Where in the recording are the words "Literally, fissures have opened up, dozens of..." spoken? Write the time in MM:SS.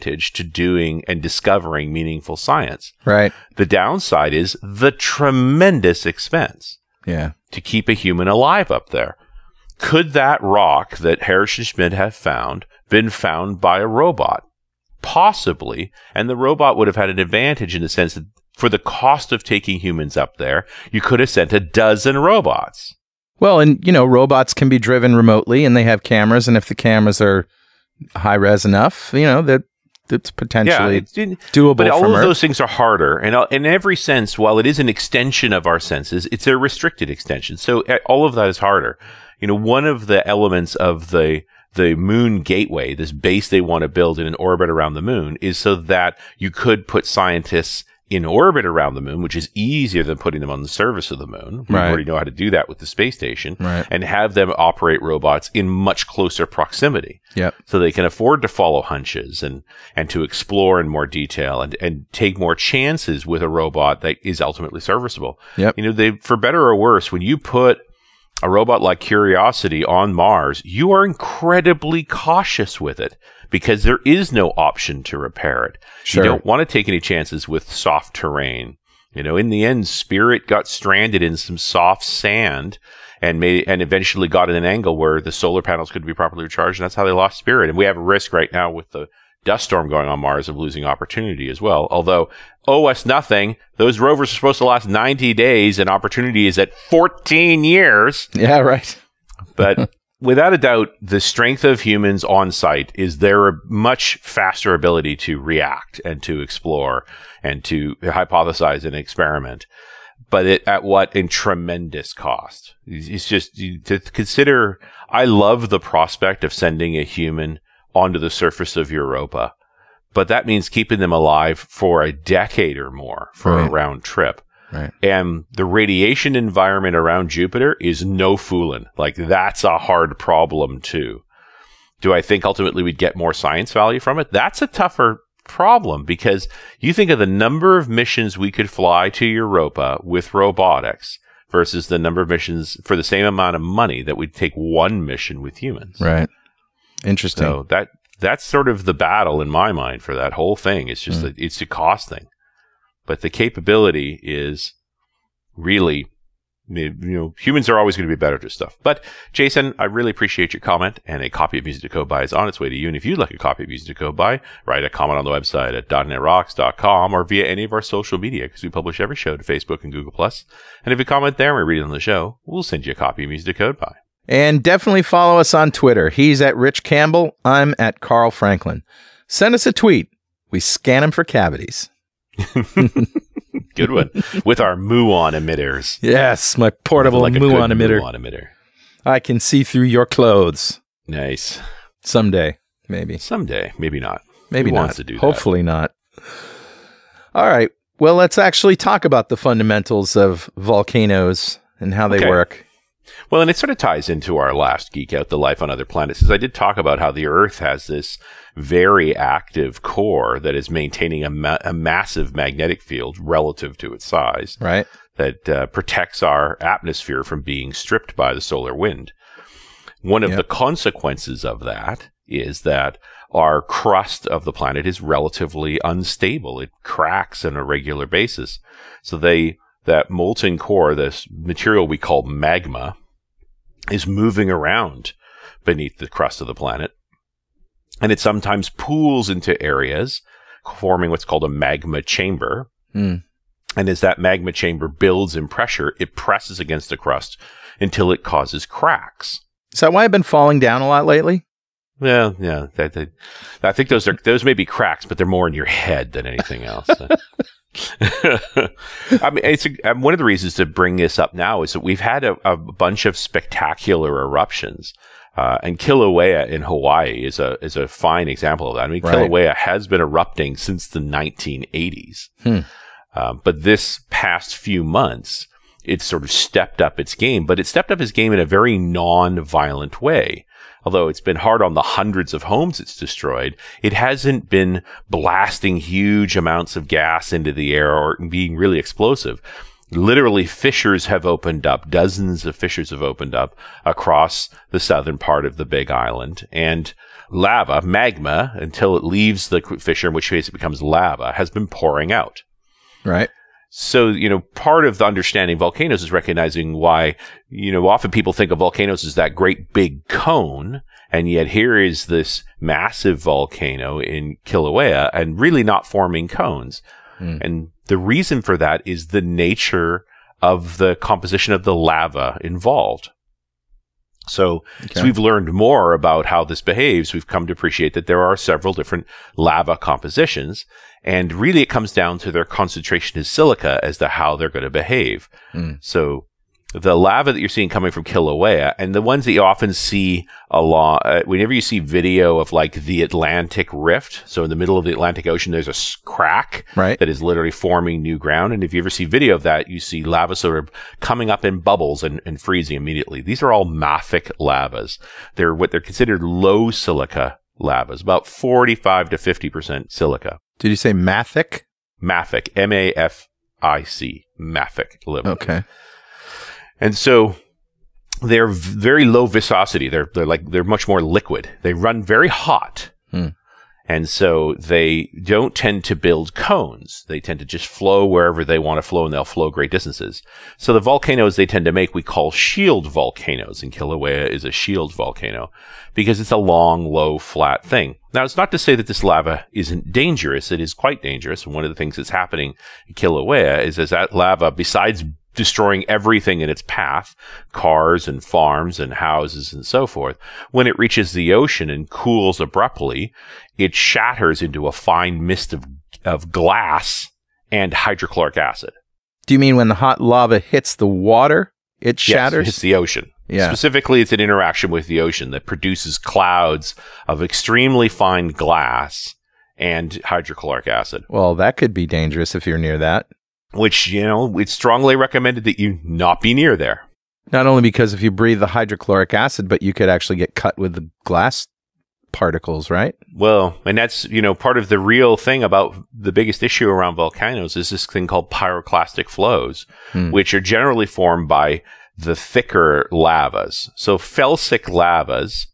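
04:49.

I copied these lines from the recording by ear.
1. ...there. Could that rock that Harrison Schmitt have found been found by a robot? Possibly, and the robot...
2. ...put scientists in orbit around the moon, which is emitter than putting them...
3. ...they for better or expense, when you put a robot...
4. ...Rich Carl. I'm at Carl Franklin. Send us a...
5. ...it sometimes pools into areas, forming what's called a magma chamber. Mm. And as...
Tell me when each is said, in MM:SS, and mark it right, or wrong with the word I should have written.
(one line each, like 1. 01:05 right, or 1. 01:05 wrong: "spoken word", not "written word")
1. 00:08 right
2. 00:46 wrong: "easier", not "emitter"
3. 01:05 wrong: "worse", not "expense"
4. 02:56 wrong: "Campbell", not "Carl"
5. 03:58 right.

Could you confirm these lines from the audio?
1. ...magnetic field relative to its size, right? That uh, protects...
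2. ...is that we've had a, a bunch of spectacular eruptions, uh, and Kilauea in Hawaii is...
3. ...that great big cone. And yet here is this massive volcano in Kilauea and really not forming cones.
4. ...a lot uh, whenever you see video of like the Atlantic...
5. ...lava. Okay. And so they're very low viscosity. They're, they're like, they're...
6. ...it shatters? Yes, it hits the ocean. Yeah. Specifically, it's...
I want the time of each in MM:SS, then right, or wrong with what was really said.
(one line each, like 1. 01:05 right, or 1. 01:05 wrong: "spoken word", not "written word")
1. 03:32 right
2. 04:21 right
3. 05:09 right
4. 05:40 right
5. 06:05 right
6. 06:51 right.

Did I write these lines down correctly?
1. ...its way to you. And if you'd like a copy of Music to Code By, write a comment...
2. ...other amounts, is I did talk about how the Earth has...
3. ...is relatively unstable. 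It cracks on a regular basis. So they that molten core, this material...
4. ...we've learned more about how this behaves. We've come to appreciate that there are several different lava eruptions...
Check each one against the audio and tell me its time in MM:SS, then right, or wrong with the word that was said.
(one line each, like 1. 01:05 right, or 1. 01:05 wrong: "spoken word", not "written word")
1. 02:42 right
2. 03:25 wrong: "planets", not "amounts"
3. 03:44 right
4. 05:25 wrong: "compositions", not "eruptions".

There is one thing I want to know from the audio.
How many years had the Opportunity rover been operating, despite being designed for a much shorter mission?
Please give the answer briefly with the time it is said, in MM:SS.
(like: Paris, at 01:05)
14 years, at 01:36.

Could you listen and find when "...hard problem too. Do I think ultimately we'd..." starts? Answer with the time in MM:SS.
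02:09.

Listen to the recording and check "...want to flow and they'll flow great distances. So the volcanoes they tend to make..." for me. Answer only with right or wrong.
right.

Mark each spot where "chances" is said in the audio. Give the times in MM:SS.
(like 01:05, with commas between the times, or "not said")
01:02, 01:16.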